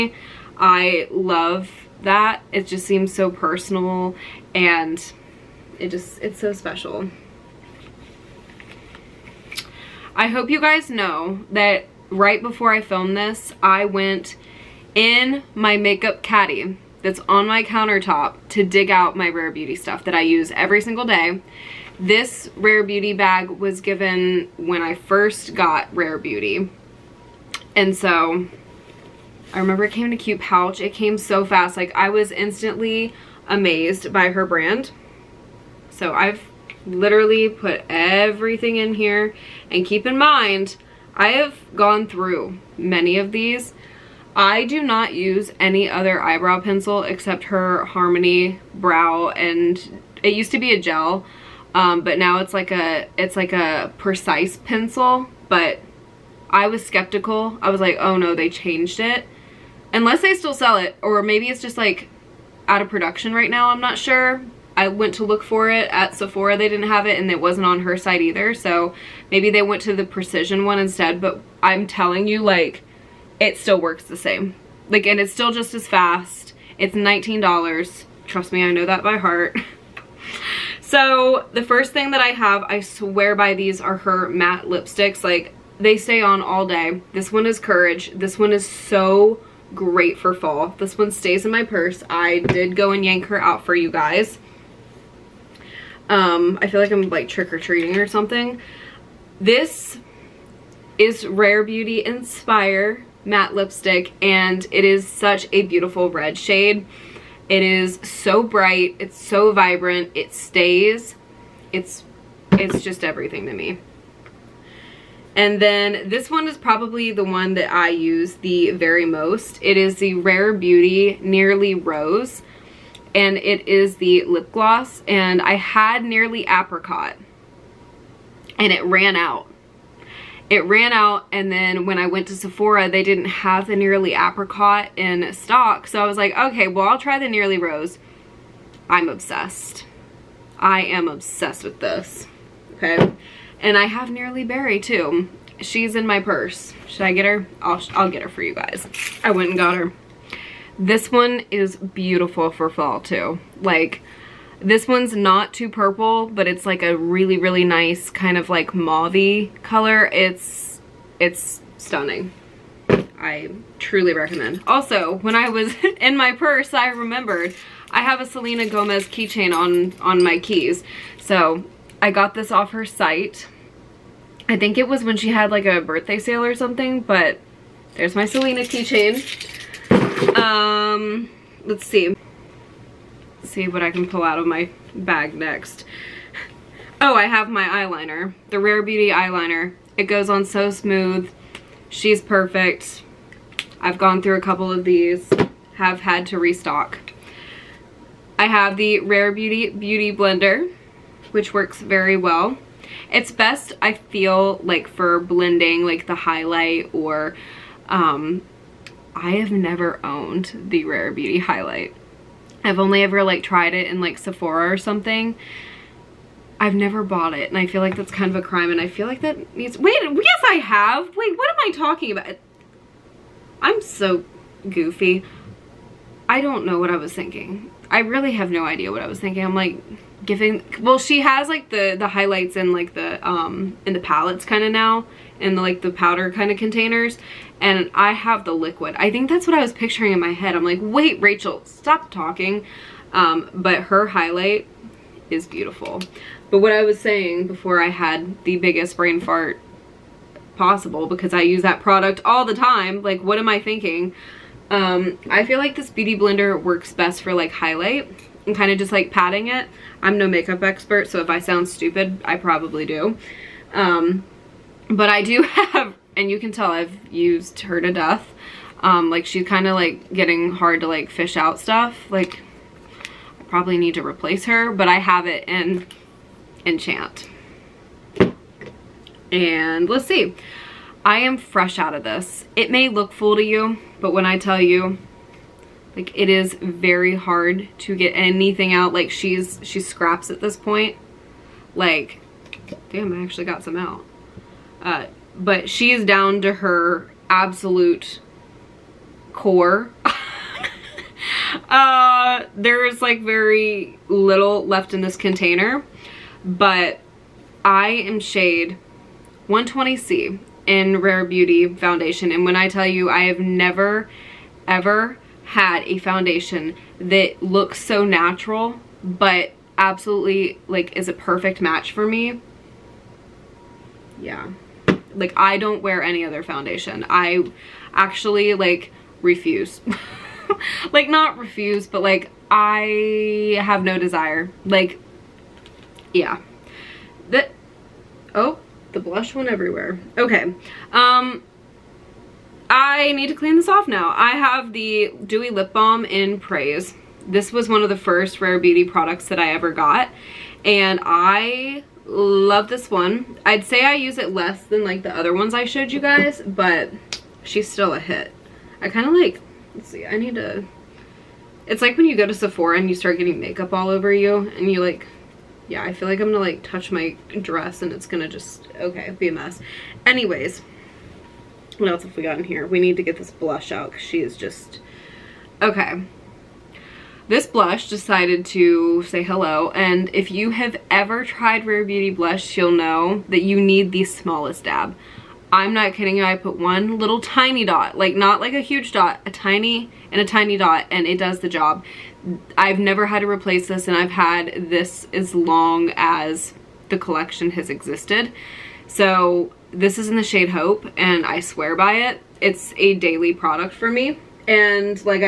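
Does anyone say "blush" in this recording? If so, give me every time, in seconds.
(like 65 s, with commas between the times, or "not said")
338 s, 373 s, 377 s, 382 s.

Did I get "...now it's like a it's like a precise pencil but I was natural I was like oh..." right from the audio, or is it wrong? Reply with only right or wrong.
wrong.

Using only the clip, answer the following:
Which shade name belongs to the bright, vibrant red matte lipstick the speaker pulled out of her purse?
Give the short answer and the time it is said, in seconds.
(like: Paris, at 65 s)
Inspire, at 102 s.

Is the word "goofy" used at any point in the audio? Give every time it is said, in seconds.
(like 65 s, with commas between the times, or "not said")
224 s.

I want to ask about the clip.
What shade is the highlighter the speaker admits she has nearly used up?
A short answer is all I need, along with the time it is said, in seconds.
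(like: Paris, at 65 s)
Enchant, at 276 s.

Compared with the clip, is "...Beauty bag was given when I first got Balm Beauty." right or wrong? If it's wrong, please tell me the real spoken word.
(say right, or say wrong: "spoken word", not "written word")
wrong: "Rare", not "Balm".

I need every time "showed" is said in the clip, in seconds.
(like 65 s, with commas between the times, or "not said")
355 s.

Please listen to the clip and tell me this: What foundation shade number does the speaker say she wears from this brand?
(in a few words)
120C.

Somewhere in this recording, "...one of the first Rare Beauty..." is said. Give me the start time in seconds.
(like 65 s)
347 s.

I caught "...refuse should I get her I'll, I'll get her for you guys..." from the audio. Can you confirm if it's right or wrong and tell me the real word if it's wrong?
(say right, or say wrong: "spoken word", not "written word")
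wrong: "purse", not "refuse".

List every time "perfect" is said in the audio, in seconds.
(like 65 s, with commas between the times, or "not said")
192 s, 321 s.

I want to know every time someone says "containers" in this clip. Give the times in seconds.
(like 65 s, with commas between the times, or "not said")
236 s, 305 s.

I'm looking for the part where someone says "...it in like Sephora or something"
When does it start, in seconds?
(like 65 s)
213 s.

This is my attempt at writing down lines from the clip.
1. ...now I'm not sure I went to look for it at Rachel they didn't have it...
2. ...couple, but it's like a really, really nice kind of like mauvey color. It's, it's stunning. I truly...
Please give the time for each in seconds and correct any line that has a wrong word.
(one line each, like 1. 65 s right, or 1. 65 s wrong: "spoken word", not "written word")
1. 63 s wrong: "Sephora", not "Rachel"
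2. 155 s wrong: "purple", not "couple".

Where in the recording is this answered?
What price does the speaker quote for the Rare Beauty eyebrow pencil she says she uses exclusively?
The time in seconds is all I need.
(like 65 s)
76 s.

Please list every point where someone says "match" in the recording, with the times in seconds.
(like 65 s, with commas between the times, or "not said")
321 s.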